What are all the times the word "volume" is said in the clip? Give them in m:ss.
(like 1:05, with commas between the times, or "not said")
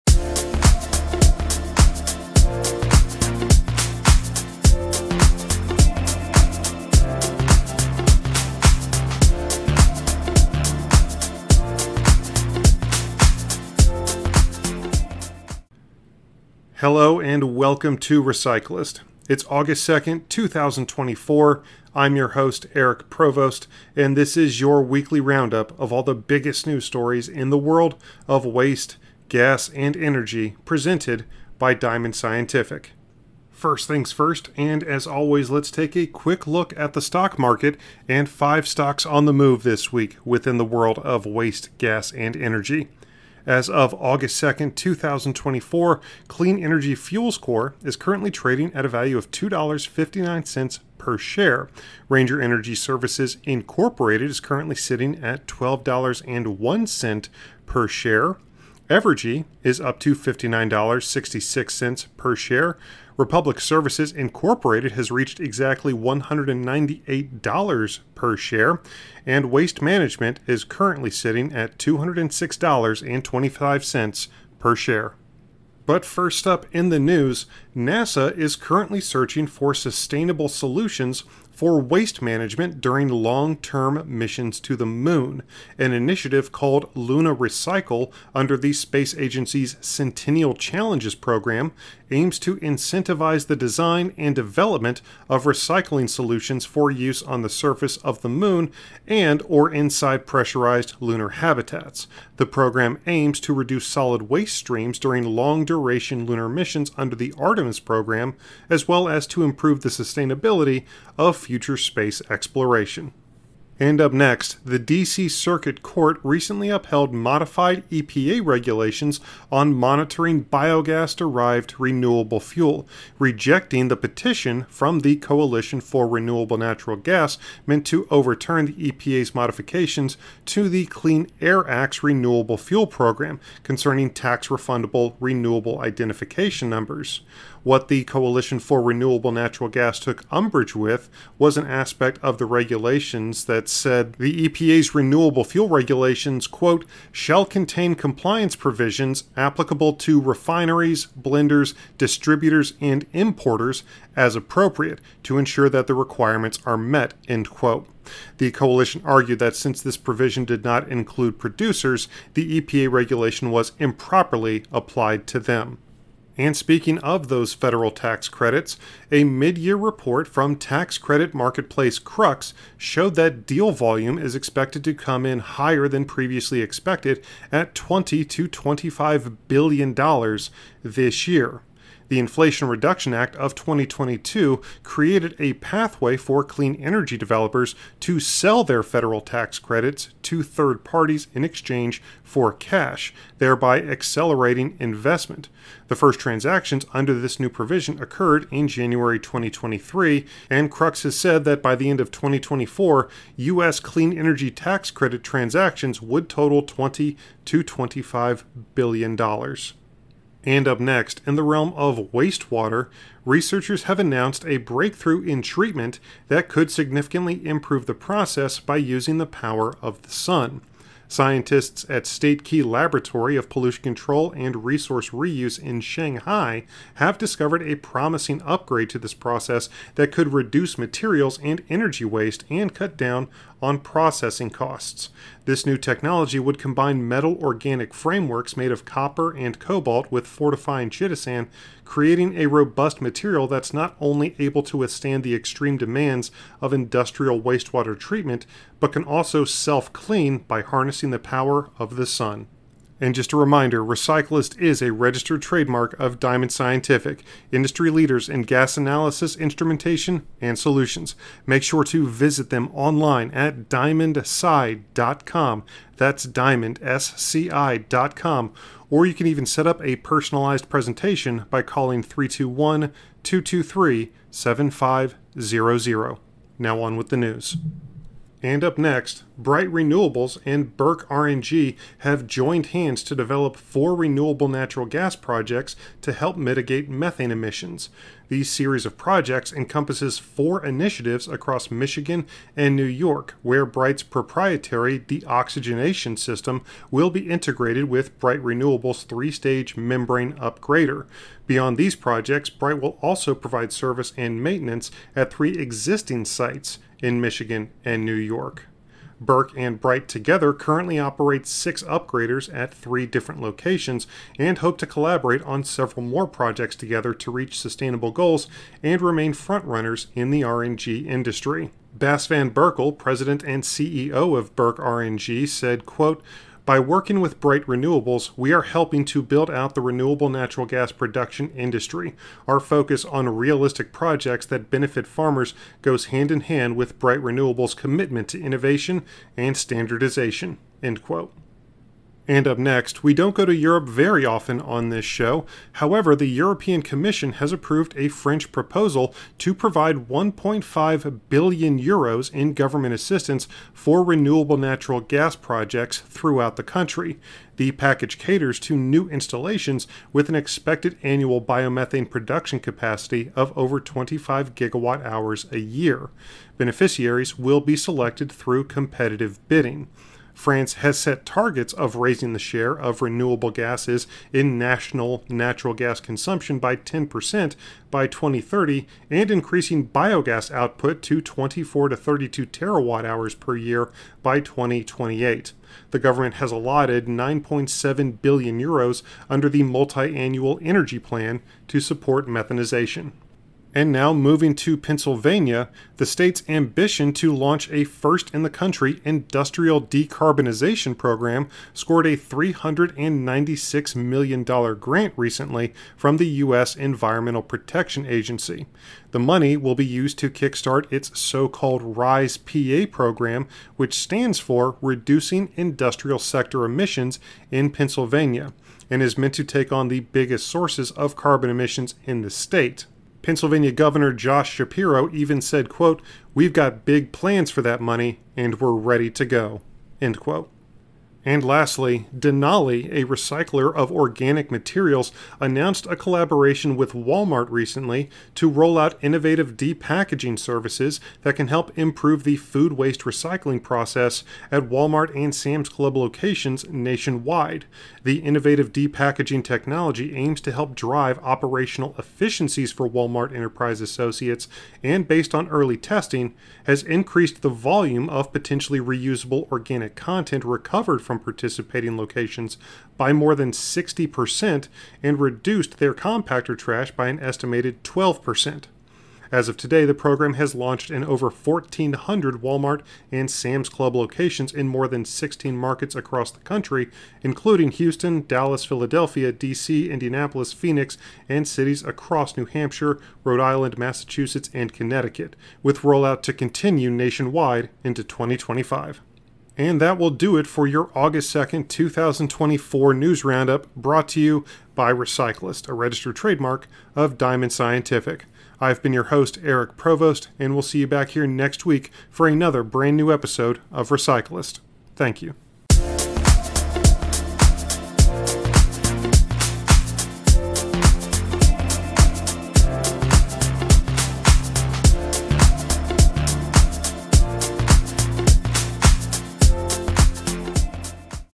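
2:53, 7:37.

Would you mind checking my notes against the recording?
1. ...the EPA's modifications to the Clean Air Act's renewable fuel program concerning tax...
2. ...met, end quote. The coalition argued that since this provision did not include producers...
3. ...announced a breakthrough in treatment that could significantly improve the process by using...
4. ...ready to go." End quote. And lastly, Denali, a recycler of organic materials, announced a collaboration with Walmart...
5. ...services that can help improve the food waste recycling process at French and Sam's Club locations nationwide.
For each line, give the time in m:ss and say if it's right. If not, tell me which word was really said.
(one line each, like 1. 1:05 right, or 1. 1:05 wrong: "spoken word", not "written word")
1. 2:08 right
2. 2:36 right
3. 3:33 right
4. 7:08 right
5. 7:20 wrong: "Walmart", not "French".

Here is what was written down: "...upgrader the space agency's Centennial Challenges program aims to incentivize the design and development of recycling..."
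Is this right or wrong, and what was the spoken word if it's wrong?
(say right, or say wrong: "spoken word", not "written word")
wrong: "under", not "upgrader".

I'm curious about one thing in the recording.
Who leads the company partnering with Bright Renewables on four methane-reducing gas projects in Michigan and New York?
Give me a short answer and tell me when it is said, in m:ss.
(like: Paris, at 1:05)
Bas Van Berkel, at 5:21.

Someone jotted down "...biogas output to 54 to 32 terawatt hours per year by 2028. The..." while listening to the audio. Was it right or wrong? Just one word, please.
wrong.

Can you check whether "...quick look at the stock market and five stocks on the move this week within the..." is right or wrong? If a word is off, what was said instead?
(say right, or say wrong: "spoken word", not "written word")
right.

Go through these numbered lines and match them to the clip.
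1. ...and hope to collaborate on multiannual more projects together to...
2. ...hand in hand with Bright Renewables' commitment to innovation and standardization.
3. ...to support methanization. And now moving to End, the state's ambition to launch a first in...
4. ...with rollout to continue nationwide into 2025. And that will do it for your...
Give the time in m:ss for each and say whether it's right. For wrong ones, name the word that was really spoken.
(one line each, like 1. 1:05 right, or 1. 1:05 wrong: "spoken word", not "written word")
1. 5:14 wrong: "several", not "multiannual"
2. 5:36 right
3. 6:31 wrong: "Pennsylvania", not "End"
4. 8:05 right.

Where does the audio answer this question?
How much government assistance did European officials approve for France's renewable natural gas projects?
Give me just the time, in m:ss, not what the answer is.
5:50.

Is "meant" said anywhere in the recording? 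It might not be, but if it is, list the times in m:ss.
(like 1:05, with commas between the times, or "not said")
2:07, 6:59.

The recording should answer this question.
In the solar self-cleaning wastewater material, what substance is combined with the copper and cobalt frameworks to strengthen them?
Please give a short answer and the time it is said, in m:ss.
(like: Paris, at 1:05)
chitosan, at 4:00.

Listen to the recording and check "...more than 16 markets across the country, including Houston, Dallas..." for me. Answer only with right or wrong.
right.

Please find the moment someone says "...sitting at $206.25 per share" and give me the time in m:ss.
1:11.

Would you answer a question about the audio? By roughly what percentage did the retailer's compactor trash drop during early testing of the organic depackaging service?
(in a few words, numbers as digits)
12%.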